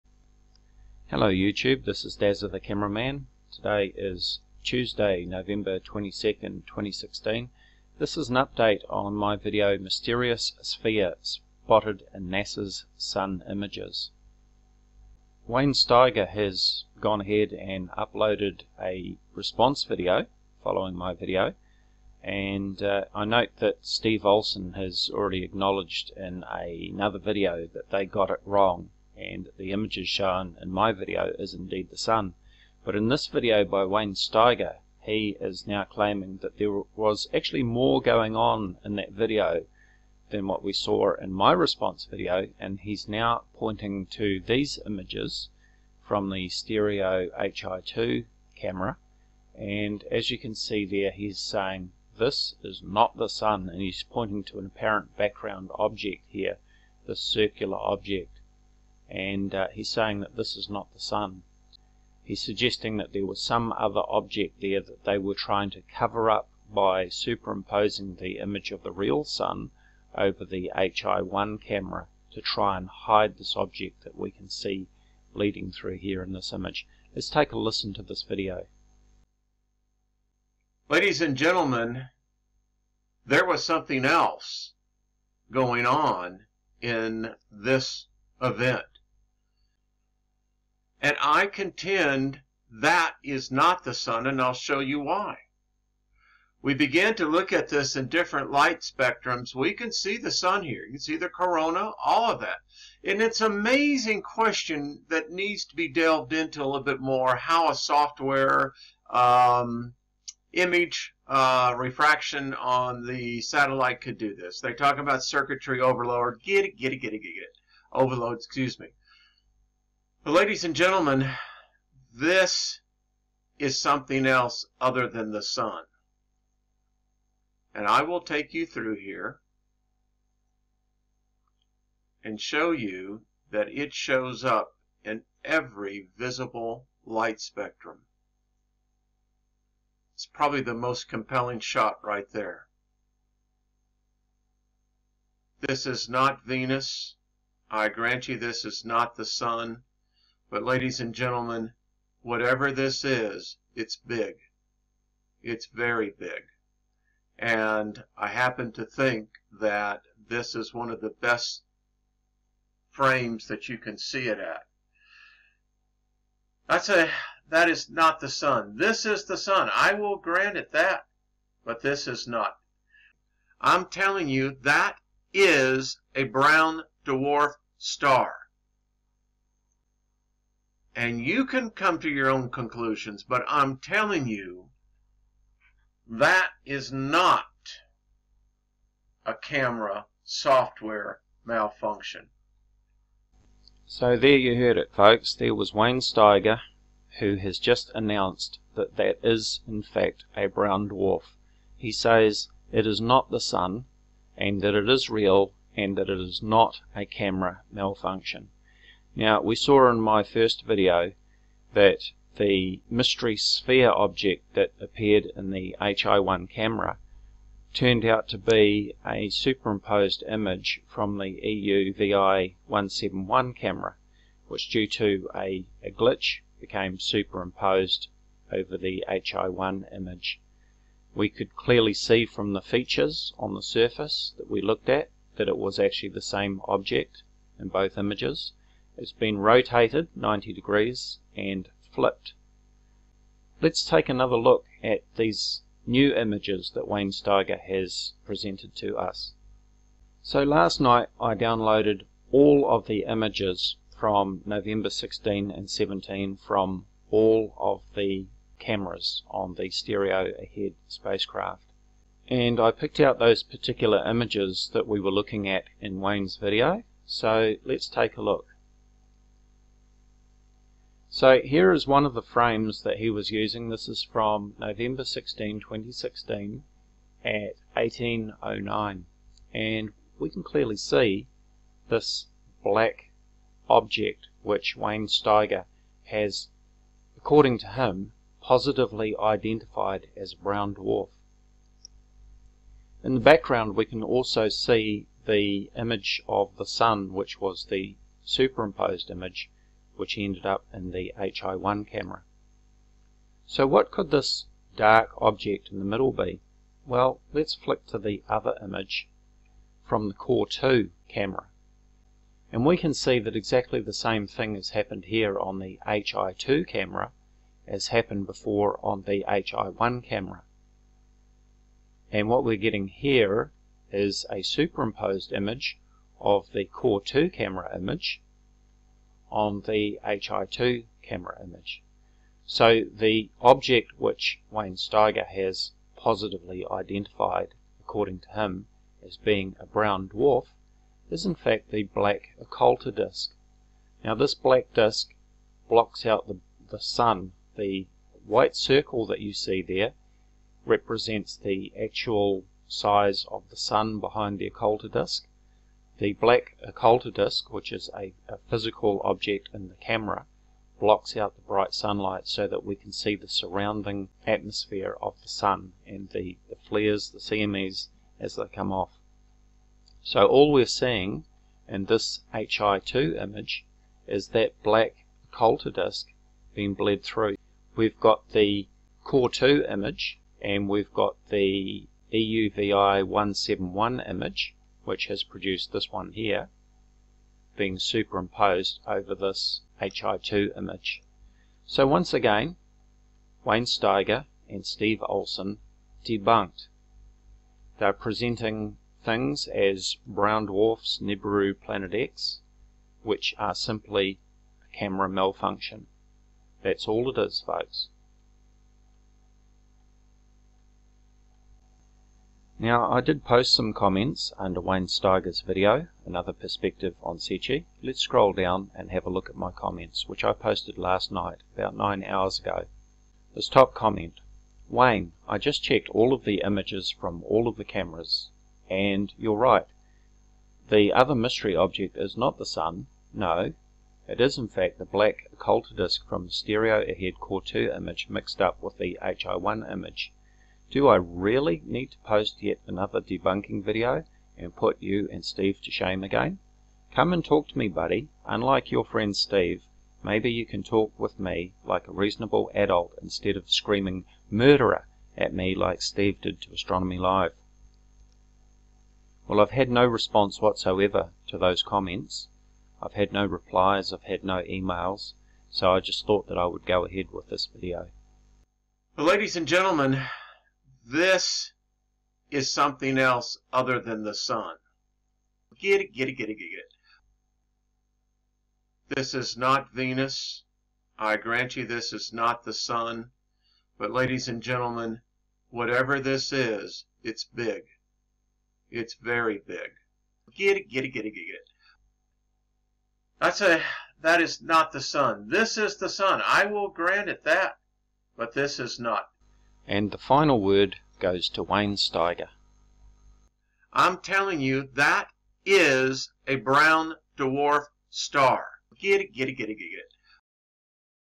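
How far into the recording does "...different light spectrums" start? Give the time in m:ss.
1:38.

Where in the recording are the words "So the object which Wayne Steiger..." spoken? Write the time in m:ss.
5:32.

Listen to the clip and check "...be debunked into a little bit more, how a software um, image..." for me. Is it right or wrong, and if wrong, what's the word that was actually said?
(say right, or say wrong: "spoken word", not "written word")
wrong: "delved", not "debunked".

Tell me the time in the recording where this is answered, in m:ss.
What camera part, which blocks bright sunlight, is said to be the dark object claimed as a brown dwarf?
5:41.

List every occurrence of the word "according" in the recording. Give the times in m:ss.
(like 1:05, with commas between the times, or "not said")
4:47, 5:37.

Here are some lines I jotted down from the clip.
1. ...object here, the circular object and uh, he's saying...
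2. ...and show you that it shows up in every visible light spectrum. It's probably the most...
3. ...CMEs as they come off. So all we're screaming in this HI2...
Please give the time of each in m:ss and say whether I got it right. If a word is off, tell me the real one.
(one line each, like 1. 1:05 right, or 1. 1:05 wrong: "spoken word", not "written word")
1. 0:55 right
2. 2:12 right
3. 6:07 wrong: "seeing", not "screaming".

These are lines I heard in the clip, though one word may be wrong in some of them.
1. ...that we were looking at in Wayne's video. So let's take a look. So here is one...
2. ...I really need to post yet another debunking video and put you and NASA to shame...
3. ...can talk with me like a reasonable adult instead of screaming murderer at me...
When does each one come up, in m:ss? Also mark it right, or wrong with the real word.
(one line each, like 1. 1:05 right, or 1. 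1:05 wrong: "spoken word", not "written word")
1. 4:24 right
2. 7:20 wrong: "Steve", not "NASA"
3. 7:30 right.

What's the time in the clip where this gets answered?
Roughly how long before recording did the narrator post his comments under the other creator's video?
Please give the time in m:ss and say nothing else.
7:01.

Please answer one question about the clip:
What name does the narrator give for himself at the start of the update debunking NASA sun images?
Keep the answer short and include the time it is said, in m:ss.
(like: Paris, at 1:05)
Dazza the cameraman, at 0:02.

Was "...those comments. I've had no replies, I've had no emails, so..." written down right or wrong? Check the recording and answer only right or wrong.
right.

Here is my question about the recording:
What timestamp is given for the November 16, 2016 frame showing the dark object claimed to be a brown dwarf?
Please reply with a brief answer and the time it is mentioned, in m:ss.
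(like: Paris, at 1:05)
1809, at 4:37.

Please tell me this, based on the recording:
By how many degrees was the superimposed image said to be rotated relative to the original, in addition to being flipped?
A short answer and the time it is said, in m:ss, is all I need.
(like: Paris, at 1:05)
90, at 4:00.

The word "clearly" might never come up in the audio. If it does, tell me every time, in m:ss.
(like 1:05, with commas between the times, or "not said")
3:51, 4:40.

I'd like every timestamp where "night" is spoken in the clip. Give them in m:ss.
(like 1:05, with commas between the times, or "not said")
4:10, 7:01.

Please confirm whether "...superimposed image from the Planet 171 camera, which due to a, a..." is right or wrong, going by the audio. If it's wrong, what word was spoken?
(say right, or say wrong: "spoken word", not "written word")
wrong: "EUVI", not "Planet".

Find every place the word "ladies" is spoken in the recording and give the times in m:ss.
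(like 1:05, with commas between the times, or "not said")
1:20, 2:00, 2:30, 7:49, 8:03.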